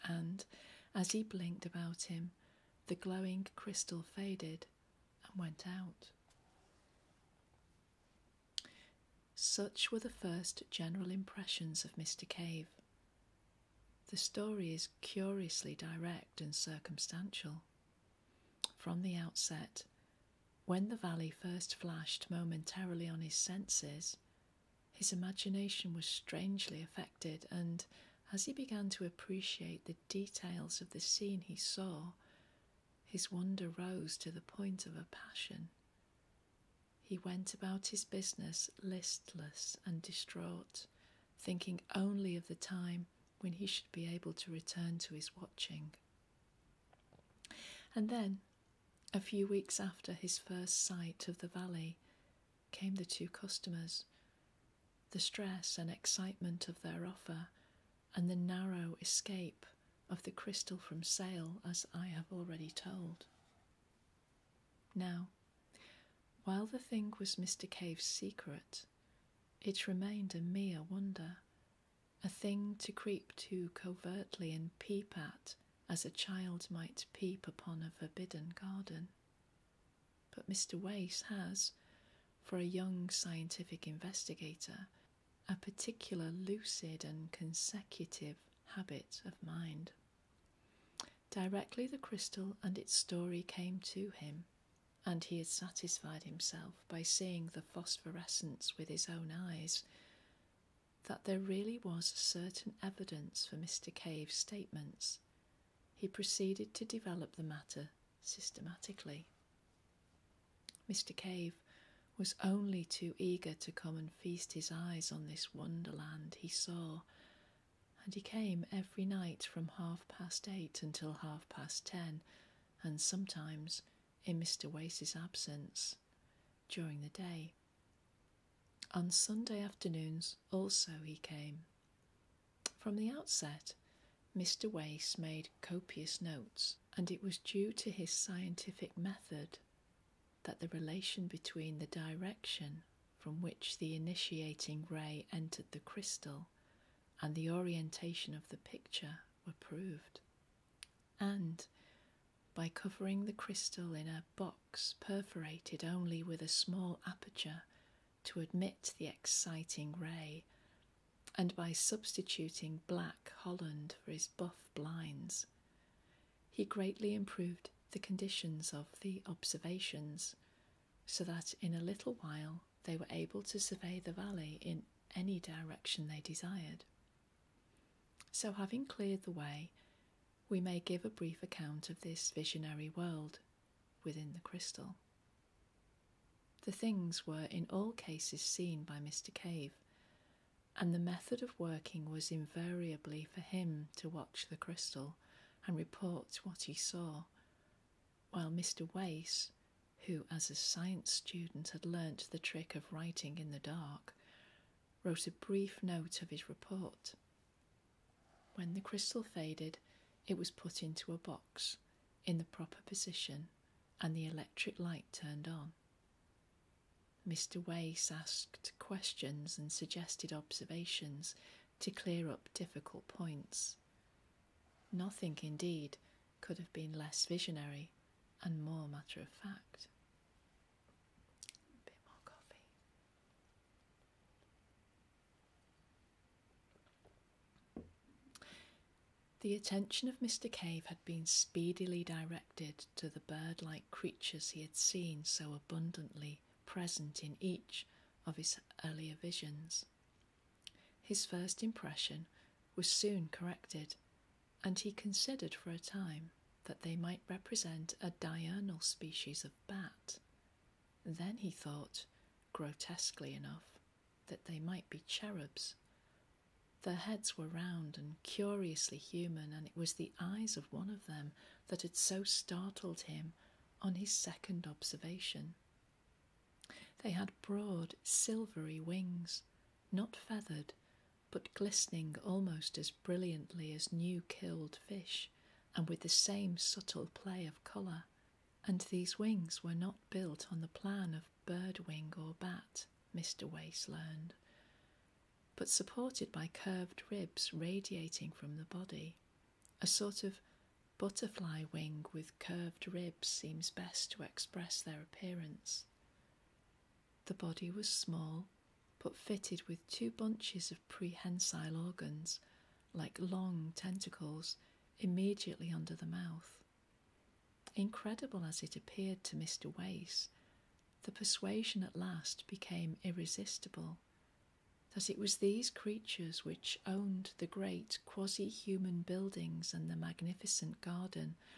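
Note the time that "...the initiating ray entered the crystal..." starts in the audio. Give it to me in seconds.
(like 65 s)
143 s.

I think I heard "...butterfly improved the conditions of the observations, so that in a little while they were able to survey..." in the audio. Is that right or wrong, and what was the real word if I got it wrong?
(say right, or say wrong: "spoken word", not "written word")
wrong: "greatly", not "butterfly".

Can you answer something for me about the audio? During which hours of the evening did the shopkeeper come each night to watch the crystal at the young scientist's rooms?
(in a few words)
8:30 to 10:30.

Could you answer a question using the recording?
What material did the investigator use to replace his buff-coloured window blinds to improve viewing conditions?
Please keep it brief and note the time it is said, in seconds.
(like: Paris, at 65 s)
Black Holland, at 162 s.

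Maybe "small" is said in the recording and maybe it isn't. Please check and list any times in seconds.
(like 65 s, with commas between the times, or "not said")
156 s, 307 s.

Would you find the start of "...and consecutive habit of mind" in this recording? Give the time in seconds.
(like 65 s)
87 s.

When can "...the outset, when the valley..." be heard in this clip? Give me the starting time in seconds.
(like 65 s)
19 s.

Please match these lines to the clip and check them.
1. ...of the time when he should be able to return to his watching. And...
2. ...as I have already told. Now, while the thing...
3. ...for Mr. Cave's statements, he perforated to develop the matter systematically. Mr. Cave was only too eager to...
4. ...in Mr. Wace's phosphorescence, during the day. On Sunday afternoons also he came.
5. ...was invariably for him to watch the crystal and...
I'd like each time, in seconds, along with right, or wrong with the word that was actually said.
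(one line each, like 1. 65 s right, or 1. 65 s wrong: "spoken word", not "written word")
1. 42 s right
2. 61 s right
3. 103 s wrong: "proceeded", not "perforated"
4. 124 s wrong: "absence", not "phosphorescence"
5. 192 s right.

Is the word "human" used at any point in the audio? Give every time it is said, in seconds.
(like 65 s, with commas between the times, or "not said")
268 s, 328 s.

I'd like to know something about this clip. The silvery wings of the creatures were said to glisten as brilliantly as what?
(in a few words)
New killed fish.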